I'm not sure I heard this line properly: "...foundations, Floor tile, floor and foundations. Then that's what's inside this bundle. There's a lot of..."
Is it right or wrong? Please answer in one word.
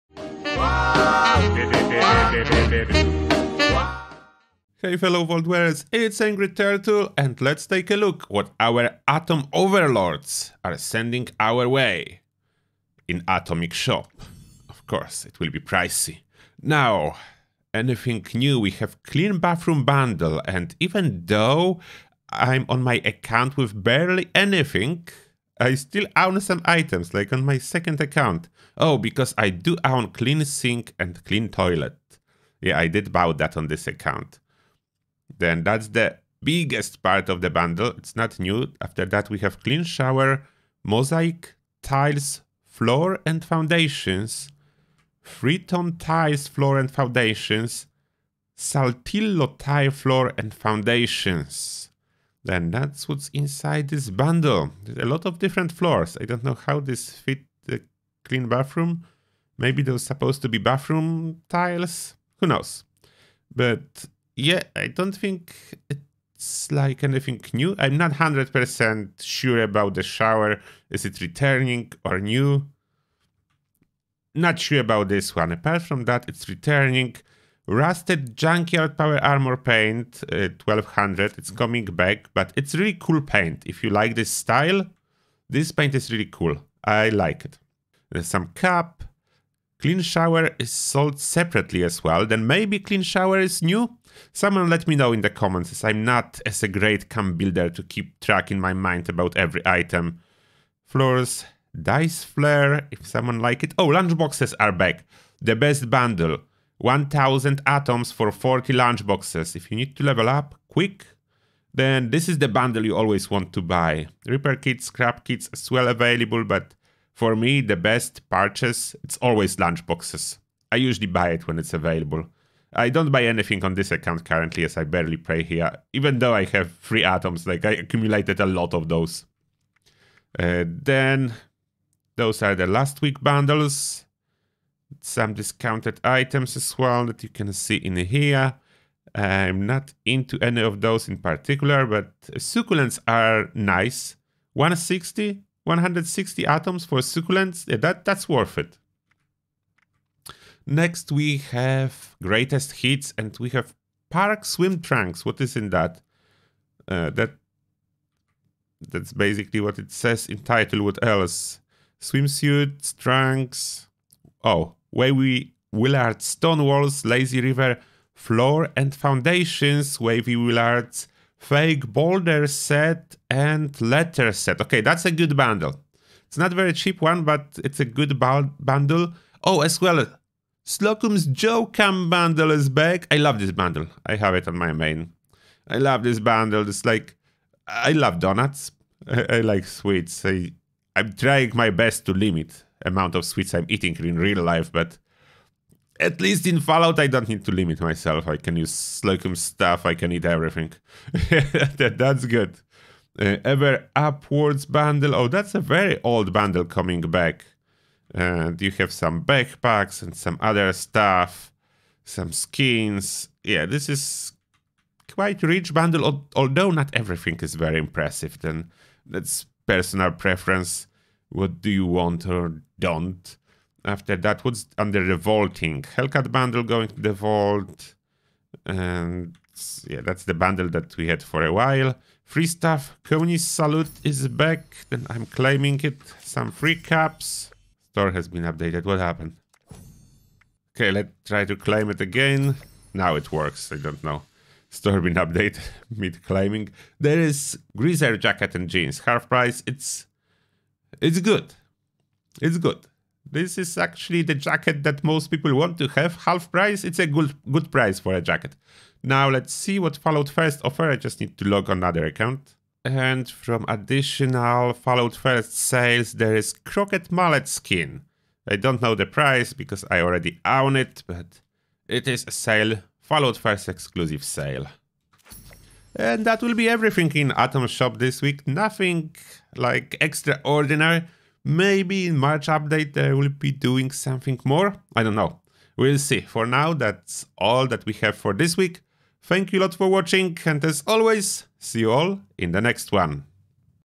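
wrong.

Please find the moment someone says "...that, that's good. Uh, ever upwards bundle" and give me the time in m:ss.
3:21.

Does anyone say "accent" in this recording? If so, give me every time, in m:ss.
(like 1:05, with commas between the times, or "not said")
not said.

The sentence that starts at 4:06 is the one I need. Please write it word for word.
There is greaser jacket and jeans, half price.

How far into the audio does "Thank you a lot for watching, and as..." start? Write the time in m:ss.
4:49.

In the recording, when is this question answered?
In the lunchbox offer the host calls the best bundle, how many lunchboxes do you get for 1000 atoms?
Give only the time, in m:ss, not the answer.
1:48.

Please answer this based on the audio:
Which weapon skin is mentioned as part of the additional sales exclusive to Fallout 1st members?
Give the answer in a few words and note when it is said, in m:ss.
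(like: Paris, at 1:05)
Crockett Mallet, at 4:26.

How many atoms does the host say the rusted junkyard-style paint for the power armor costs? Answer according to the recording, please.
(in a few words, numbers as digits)
1200.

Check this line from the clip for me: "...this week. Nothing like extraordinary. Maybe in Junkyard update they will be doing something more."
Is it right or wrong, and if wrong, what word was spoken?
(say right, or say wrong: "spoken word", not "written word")
wrong: "March", not "Junkyard".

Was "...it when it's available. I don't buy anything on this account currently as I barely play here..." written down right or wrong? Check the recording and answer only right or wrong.
right.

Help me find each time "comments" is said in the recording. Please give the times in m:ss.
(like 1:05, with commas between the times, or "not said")
1:35.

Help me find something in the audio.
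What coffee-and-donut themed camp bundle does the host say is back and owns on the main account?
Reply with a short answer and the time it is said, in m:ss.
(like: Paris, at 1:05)
Slocum's Joe, at 3:00.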